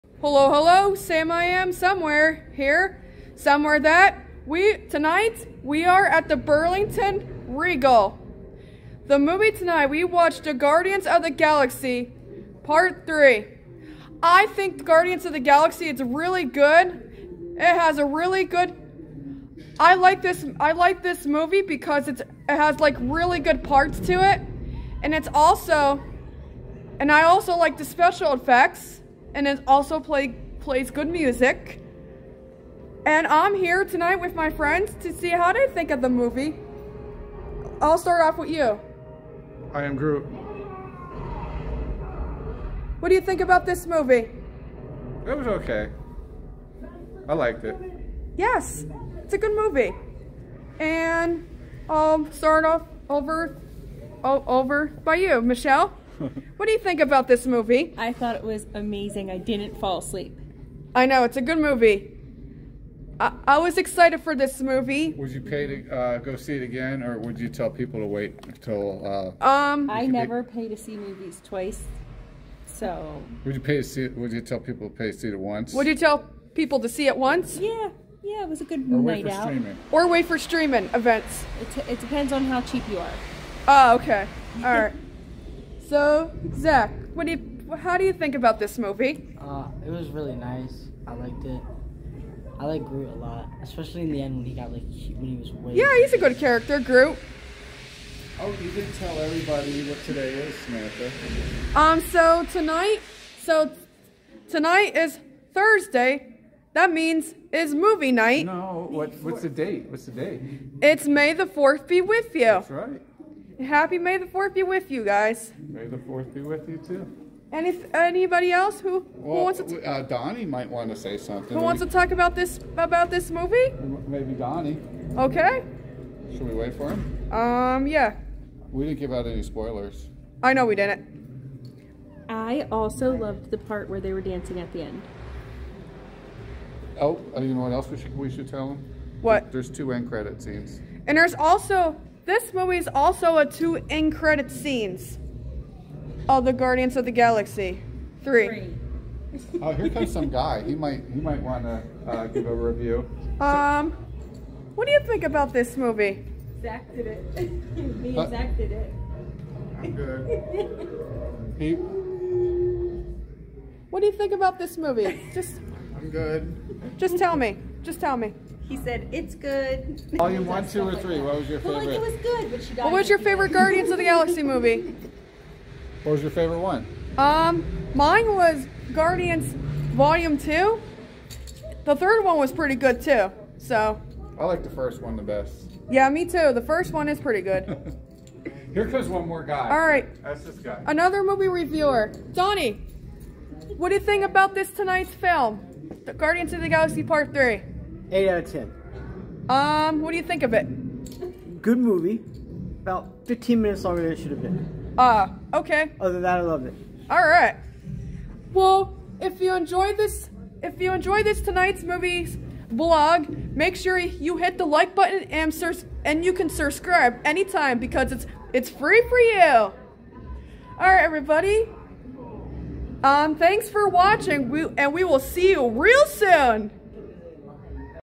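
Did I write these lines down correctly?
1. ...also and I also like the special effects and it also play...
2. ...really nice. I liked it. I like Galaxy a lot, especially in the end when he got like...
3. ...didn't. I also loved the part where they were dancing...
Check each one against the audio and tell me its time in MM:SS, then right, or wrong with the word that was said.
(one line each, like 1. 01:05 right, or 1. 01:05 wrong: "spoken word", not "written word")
1. 00:25 right
2. 01:30 wrong: "Groot", not "Galaxy"
3. 02:10 right.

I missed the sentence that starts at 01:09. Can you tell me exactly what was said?
Uh, um, I never pay to see movies twice, so.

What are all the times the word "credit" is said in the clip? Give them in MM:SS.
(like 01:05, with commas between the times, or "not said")
02:20, 02:24.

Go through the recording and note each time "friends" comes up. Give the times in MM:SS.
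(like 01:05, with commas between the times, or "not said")
00:34.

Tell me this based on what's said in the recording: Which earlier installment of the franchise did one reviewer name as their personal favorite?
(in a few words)
Guardians Volume 2.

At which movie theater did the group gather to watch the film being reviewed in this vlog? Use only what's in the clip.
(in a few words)
Burlington Regal.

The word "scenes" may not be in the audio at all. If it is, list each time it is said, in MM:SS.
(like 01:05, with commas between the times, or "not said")
02:20, 02:24.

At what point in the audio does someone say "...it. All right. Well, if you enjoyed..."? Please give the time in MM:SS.
03:26.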